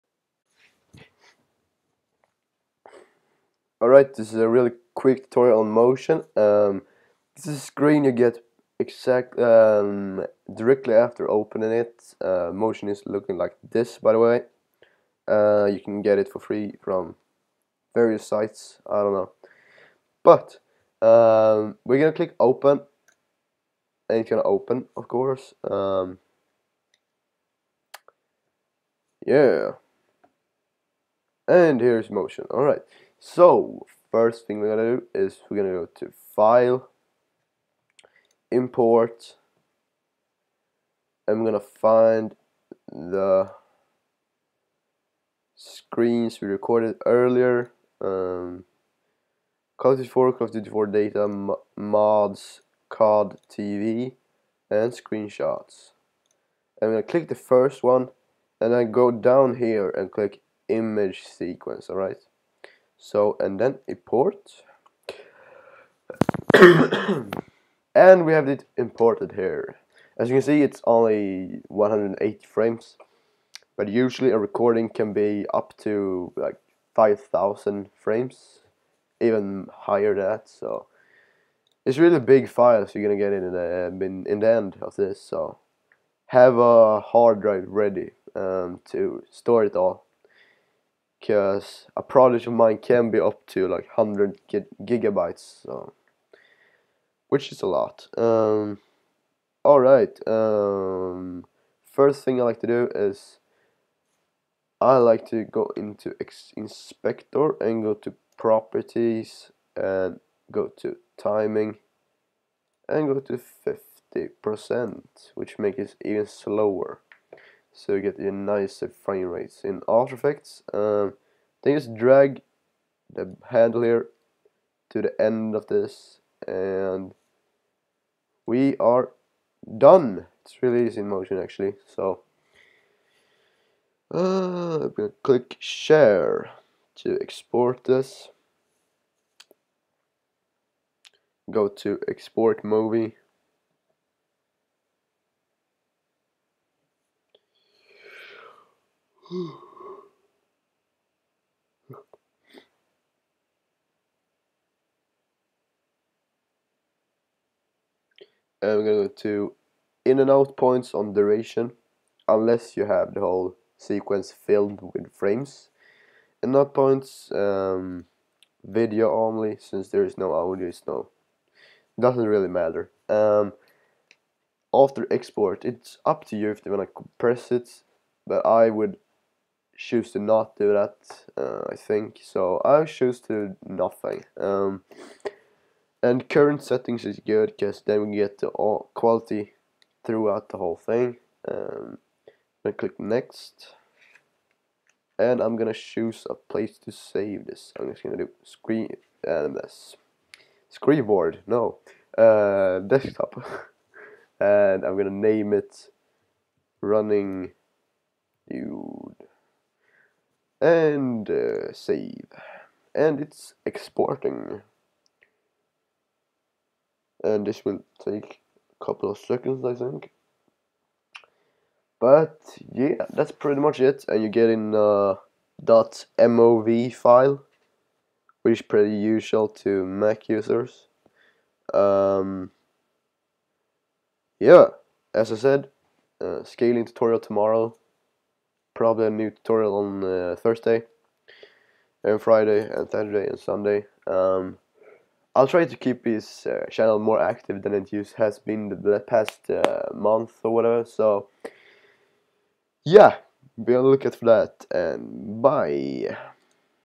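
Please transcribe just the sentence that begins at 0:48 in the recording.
Um, Call of Duty 4, Call of Duty 4 data, mods, COD TV, and screenshots.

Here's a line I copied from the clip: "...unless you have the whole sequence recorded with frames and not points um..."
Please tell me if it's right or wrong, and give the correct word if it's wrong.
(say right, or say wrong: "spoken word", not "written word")
wrong: "filled", not "recorded".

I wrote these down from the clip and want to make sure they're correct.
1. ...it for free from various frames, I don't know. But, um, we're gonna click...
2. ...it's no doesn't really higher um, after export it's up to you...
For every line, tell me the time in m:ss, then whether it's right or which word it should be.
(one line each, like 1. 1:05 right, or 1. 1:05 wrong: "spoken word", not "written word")
1. 0:16 wrong: "sites", not "frames"
2. 2:50 wrong: "matter", not "higher".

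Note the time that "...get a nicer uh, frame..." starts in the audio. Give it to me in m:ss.
1:58.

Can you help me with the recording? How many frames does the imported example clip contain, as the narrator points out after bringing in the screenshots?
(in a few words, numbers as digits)
180.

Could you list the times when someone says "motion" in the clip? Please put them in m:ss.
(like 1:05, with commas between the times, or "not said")
0:05, 0:12, 0:32, 2:11.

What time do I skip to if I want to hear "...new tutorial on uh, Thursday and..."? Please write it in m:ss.
3:59.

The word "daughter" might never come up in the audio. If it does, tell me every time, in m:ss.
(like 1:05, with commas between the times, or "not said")
not said.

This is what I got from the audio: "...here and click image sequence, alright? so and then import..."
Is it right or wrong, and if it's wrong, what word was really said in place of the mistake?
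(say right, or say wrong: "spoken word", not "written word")
right.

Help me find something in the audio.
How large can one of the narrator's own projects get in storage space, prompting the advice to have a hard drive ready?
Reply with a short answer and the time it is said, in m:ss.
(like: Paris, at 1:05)
100 gigabytes, at 1:33.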